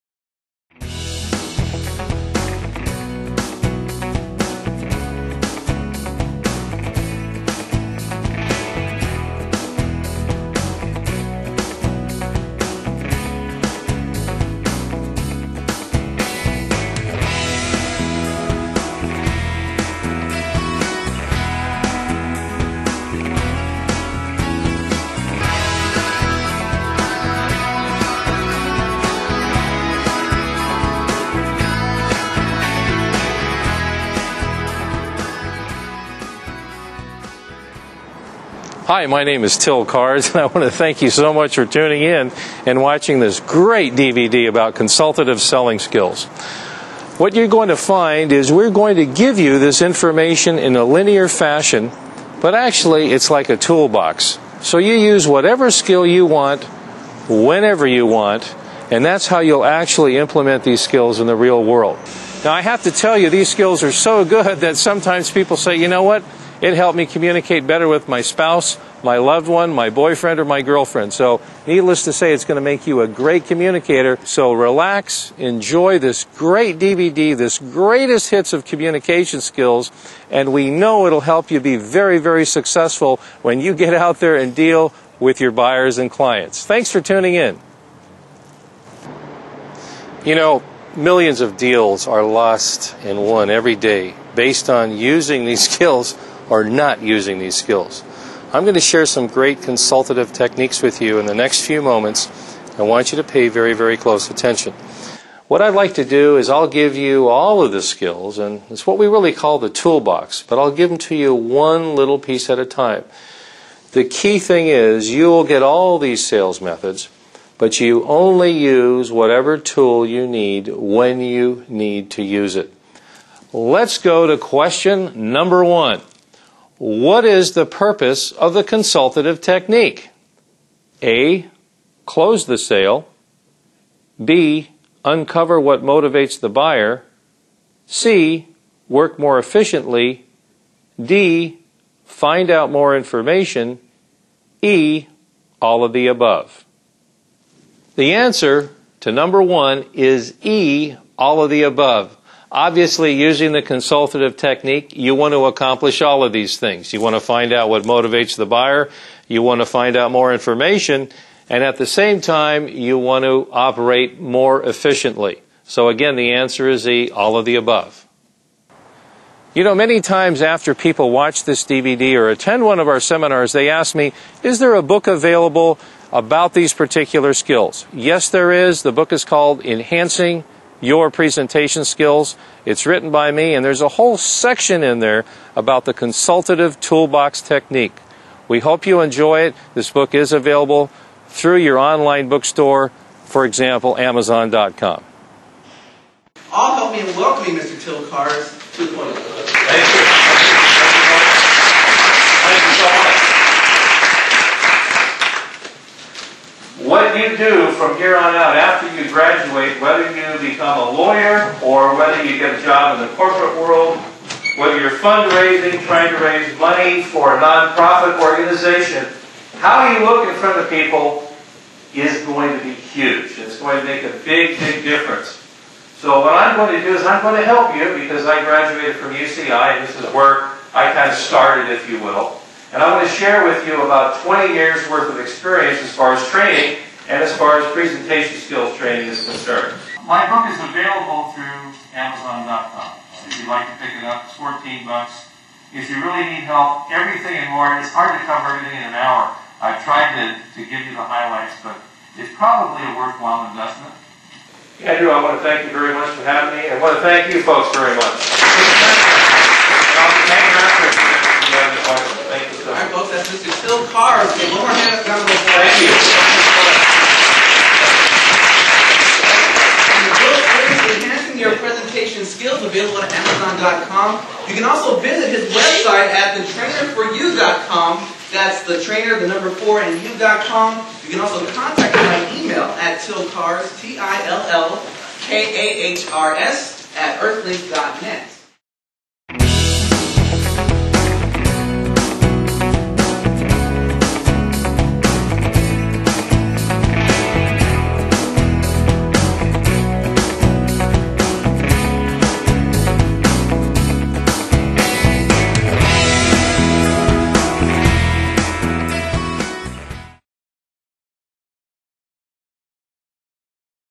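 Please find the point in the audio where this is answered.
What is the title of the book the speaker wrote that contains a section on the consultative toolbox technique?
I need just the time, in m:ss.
2:59.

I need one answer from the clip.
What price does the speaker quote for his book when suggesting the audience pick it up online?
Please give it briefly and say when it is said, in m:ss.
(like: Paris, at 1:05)
$14, at 4:04.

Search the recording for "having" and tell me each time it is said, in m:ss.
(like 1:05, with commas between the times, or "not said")
4:16.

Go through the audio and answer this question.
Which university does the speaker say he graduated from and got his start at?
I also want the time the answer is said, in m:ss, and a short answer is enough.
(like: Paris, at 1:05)
UCI, at 3:49.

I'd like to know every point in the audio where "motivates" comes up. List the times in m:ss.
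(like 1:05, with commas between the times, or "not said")
2:15, 2:37.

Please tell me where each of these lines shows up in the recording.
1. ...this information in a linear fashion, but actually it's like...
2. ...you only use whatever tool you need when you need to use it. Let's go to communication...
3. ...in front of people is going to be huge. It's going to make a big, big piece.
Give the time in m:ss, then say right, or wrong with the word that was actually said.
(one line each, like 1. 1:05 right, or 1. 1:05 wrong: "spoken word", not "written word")
1. 0:49 right
2. 1:57 wrong: "question", not "communication"
3. 3:40 wrong: "difference", not "piece".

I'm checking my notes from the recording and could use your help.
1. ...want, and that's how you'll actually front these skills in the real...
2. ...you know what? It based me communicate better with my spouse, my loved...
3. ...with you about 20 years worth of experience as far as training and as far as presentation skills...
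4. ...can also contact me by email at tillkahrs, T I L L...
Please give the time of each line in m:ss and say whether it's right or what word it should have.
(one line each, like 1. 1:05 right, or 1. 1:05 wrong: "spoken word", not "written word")
1. 0:58 wrong: "implement", not "front"
2. 1:05 wrong: "helped", not "based"
3. 3:53 right
4. 4:41 right.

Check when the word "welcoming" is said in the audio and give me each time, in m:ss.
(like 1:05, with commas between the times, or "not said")
3:17.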